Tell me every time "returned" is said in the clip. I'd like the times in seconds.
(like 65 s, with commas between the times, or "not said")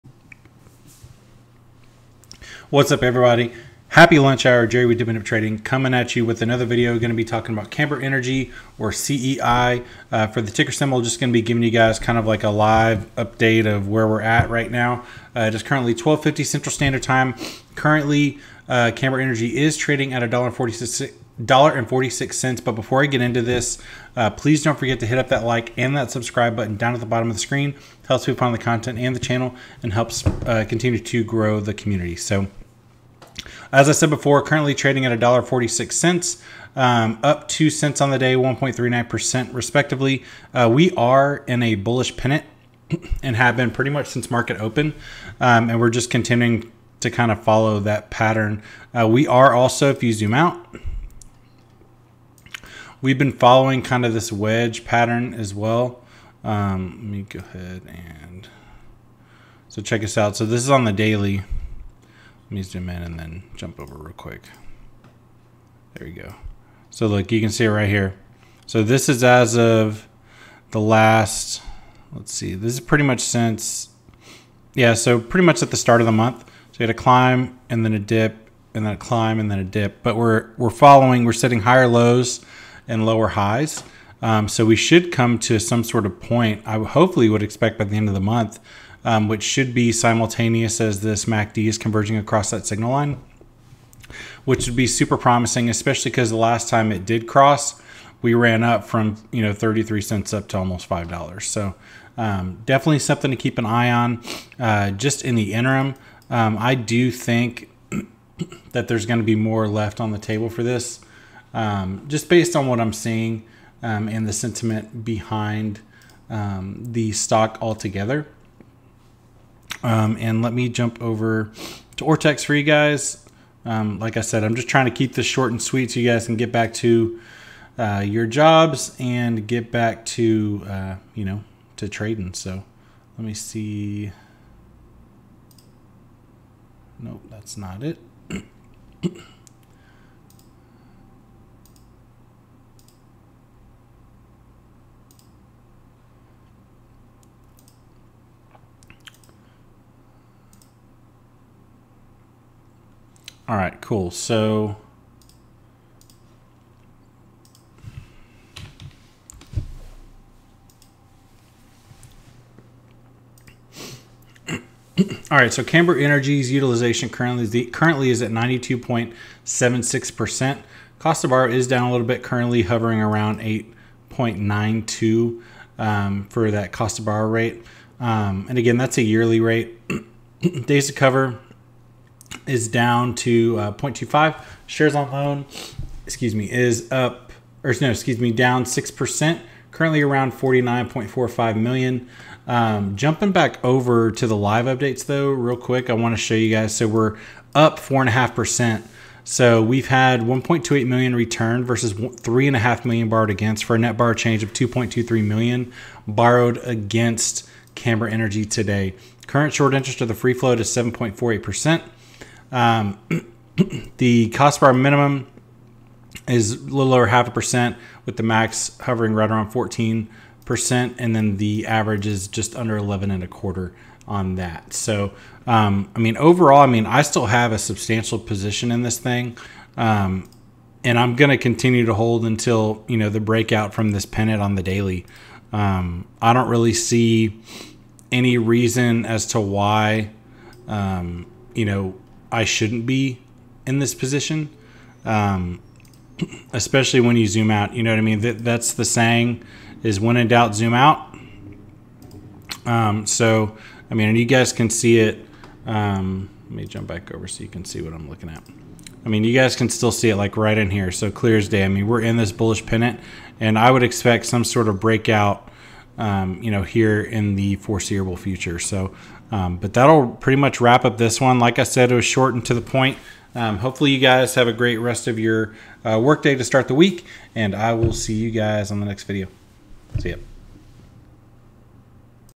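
201 s.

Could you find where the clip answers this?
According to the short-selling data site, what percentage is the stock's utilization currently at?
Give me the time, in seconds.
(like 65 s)
168 s.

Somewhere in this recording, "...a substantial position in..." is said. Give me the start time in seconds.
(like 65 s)
227 s.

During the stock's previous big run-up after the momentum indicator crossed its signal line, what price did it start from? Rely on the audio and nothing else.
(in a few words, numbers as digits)
33 cents.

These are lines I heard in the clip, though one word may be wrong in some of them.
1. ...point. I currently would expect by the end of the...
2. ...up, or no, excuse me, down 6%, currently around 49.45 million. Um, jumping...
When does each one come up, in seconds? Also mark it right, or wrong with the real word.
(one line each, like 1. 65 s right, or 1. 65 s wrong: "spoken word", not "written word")
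1. 86 s wrong: "hopefully", not "currently"
2. 186 s right.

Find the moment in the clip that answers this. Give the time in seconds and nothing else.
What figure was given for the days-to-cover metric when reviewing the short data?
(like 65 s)
183 s.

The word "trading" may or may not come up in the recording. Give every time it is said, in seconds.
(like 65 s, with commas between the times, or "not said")
5 s, 19 s, 34 s, 131 s.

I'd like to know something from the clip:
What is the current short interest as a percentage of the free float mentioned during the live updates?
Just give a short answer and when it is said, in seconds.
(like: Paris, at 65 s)
7.48%, at 210 s.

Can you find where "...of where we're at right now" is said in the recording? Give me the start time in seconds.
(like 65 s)
13 s.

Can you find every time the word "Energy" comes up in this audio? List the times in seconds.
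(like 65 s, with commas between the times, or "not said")
7 s, 19 s, 165 s, 208 s.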